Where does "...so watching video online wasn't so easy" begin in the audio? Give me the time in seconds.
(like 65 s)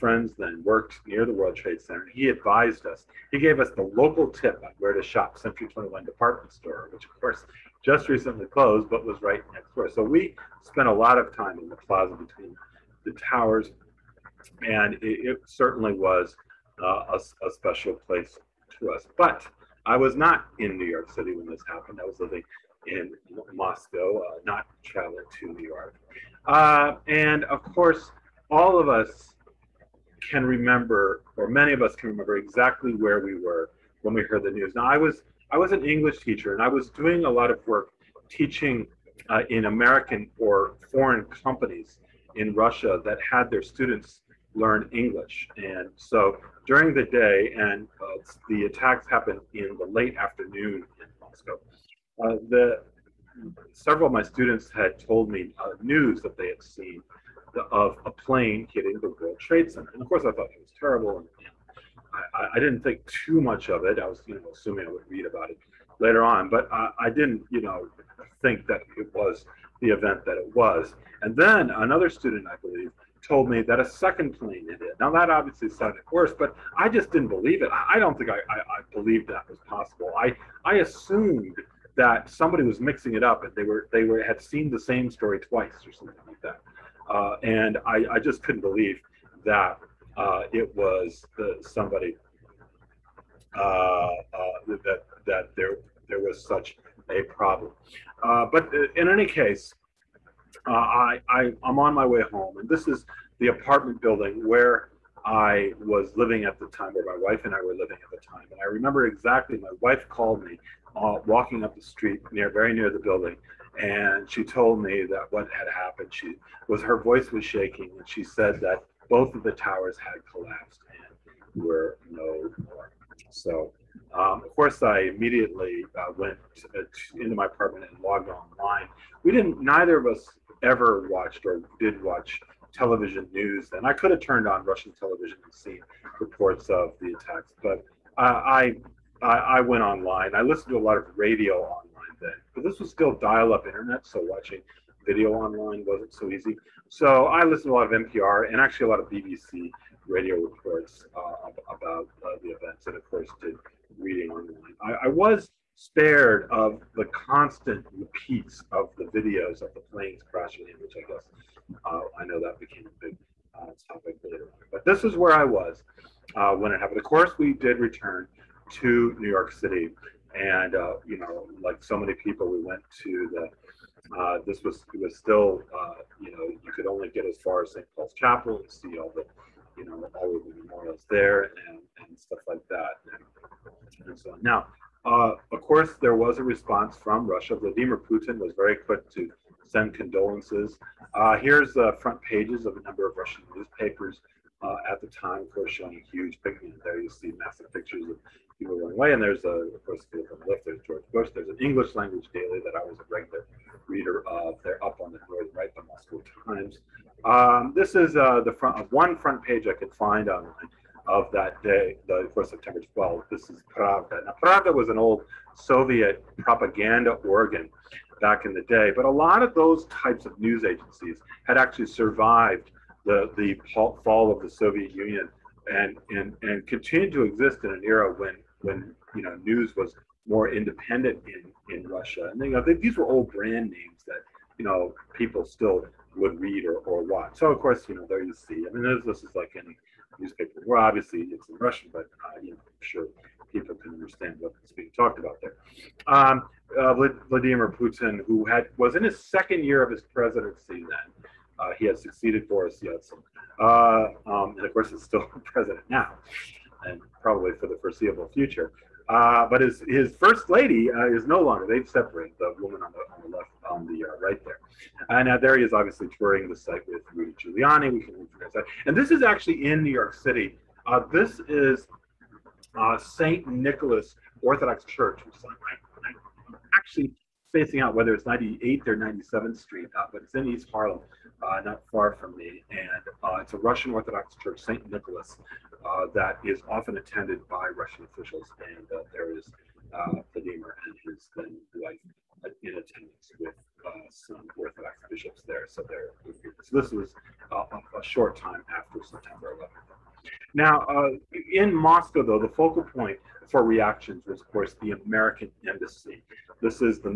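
144 s.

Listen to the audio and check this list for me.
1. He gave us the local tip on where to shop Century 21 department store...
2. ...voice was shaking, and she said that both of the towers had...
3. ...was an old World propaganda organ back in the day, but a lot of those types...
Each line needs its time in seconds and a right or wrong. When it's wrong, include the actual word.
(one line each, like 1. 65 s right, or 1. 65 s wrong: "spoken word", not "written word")
1. 3 s right
2. 117 s right
3. 214 s wrong: "Soviet", not "World".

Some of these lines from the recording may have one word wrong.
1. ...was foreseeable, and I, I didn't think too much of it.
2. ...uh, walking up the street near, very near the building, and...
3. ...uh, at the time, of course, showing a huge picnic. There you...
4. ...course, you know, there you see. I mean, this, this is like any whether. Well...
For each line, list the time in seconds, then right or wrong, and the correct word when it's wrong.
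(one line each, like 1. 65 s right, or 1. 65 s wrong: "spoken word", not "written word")
1. 60 s wrong: "terrible", not "foreseeable"
2. 110 s right
3. 194 s right
4. 237 s wrong: "newspaper", not "whether".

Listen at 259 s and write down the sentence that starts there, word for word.
Uh, but his his first lady uh, is no longer.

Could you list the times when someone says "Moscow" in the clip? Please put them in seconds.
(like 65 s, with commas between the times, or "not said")
23 s, 51 s, 205 s, 301 s.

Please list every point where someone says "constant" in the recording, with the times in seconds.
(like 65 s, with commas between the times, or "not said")
157 s.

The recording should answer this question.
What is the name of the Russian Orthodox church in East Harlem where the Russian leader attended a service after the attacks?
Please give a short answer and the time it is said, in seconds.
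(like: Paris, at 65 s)
Saint Nicholas Orthodox Church, at 272 s.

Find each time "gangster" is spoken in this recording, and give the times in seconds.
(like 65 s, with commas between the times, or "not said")
not said.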